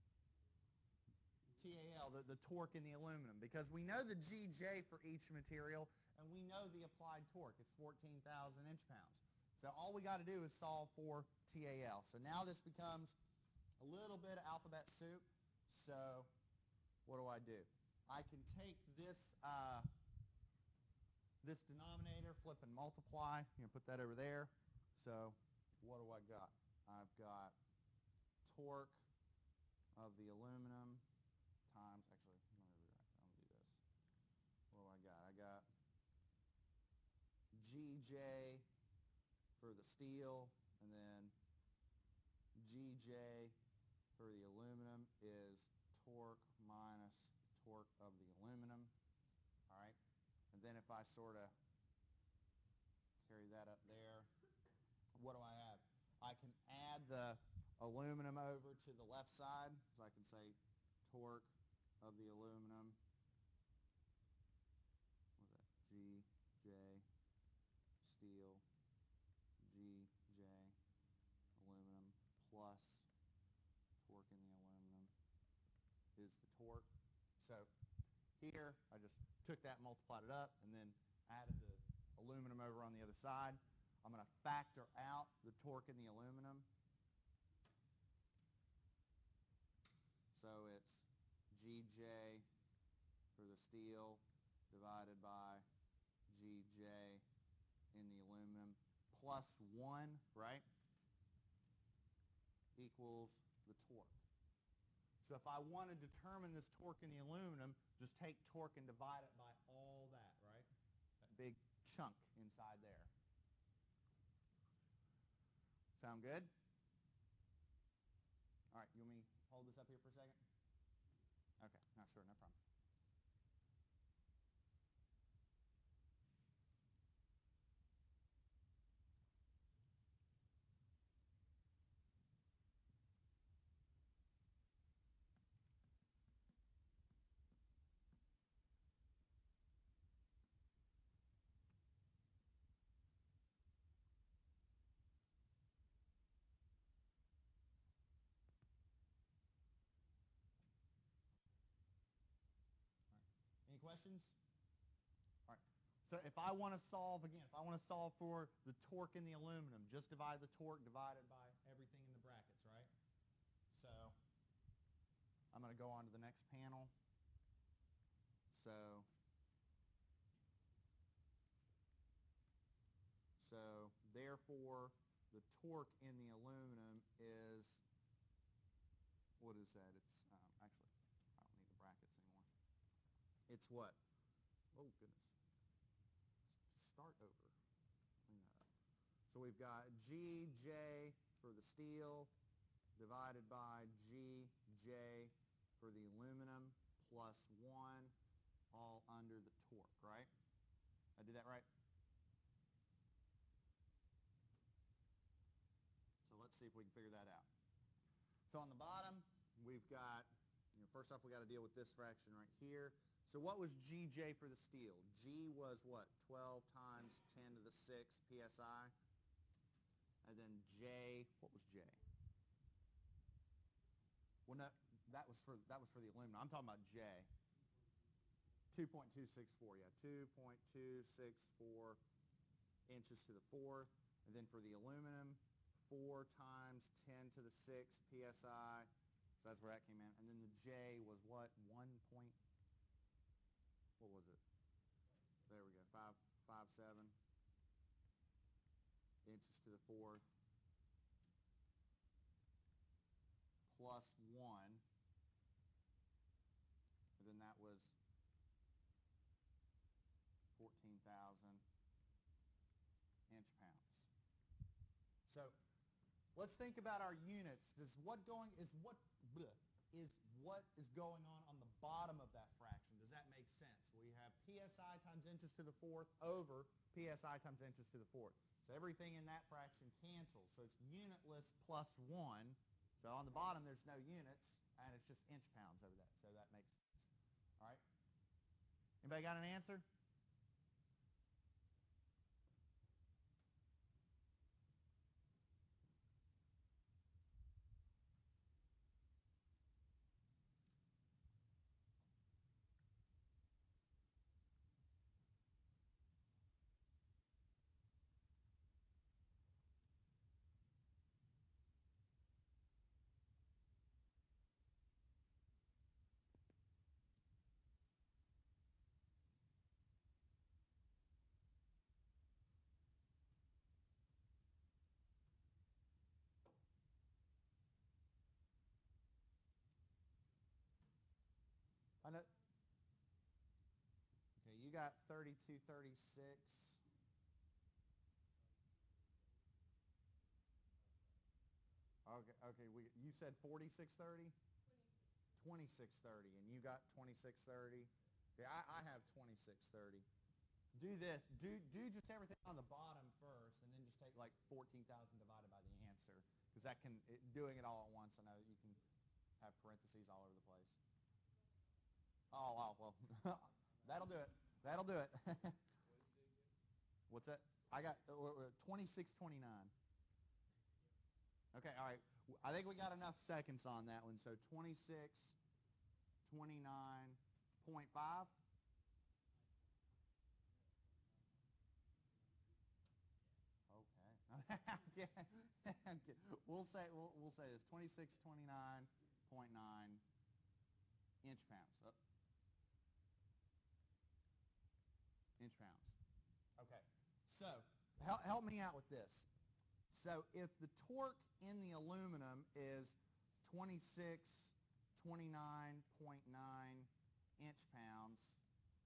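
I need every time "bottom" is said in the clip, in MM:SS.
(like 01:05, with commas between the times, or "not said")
03:28, 04:31, 04:43, 05:52.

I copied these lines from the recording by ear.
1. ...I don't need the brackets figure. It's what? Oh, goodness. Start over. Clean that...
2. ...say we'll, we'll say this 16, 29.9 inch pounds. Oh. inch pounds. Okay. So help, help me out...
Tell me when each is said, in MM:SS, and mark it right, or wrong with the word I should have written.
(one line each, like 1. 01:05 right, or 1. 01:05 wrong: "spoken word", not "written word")
1. 03:01 wrong: "anymore", not "figure"
2. 06:26 wrong: "26", not "16".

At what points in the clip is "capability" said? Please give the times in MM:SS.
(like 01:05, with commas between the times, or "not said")
not said.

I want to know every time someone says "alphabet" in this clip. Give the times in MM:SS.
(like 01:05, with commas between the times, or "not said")
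00:14.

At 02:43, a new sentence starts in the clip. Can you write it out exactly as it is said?
So I'm going to go on to the next panel.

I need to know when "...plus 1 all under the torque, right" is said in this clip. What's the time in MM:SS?
03:17.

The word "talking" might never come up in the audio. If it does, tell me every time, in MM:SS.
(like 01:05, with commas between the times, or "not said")
03:46.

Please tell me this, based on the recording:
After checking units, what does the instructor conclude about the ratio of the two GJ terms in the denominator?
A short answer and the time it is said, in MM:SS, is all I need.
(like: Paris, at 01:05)
unitless, at 04:40.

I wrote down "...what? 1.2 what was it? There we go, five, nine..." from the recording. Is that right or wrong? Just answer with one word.
wrong.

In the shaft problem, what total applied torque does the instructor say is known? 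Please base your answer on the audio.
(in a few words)
14,000 inch-pounds.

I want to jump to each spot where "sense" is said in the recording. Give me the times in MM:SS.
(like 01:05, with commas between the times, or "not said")
04:33, 04:46.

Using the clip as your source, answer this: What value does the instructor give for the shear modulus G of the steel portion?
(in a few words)
12 times 10^6 psi.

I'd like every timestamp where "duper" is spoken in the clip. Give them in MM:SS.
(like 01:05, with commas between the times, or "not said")
not said.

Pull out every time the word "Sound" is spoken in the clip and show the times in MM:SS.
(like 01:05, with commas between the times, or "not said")
01:55.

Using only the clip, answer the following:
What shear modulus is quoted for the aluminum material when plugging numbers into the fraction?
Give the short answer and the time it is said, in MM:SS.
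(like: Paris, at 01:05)
4 times 10^6 psi, at 03:55.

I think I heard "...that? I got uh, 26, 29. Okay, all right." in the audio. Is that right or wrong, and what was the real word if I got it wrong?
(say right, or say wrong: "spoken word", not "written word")
right.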